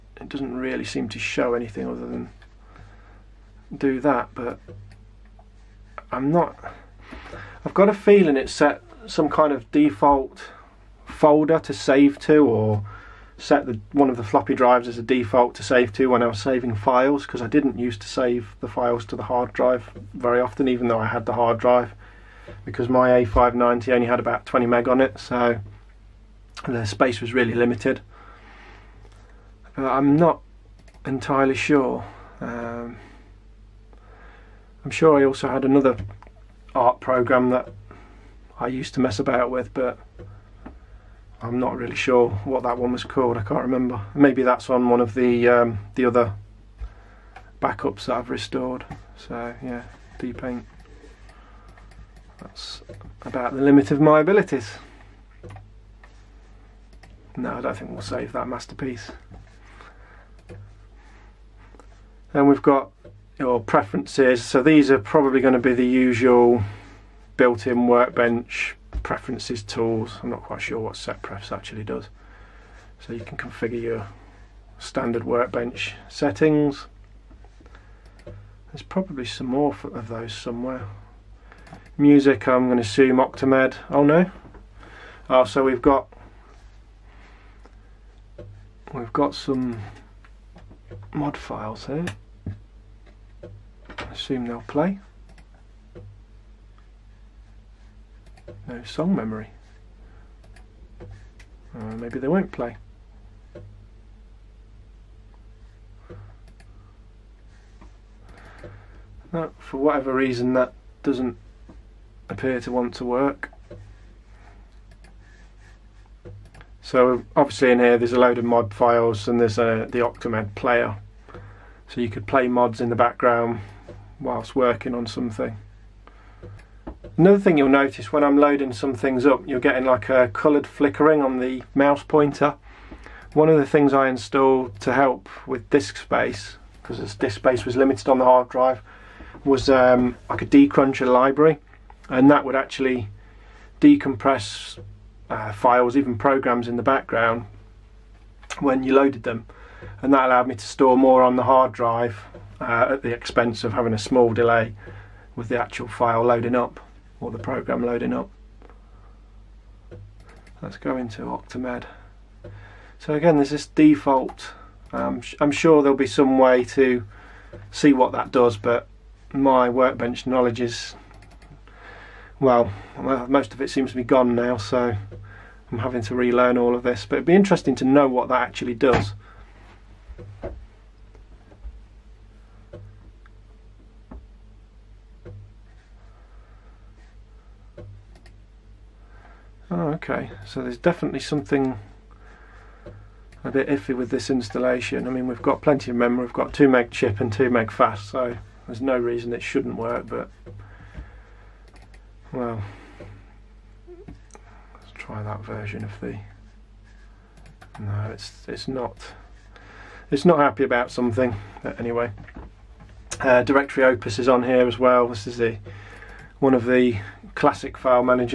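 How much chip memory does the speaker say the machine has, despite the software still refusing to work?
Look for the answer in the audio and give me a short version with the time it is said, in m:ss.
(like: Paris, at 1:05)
2 meg, at 3:16.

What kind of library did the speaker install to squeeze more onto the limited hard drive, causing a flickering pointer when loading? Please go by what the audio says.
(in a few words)
decruncher library.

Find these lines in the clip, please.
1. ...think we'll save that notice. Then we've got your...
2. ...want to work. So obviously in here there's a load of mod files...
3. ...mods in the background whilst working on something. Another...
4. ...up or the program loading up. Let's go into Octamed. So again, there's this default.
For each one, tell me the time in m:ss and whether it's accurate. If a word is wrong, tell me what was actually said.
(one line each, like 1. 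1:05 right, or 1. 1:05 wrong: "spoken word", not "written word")
1. 0:57 wrong: "masterpiece", not "notice"
2. 1:52 right
3. 2:02 right
4. 2:36 right.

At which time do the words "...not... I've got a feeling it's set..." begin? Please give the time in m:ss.
0:06.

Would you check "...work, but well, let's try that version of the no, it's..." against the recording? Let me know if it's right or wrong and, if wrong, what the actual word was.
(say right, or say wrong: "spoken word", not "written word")
right.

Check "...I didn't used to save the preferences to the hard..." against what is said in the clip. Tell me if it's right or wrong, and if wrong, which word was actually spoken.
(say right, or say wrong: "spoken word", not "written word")
wrong: "files", not "preferences".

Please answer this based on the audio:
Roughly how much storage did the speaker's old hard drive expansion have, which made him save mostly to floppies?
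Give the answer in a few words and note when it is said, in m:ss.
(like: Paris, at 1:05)
20 meg, at 0:24.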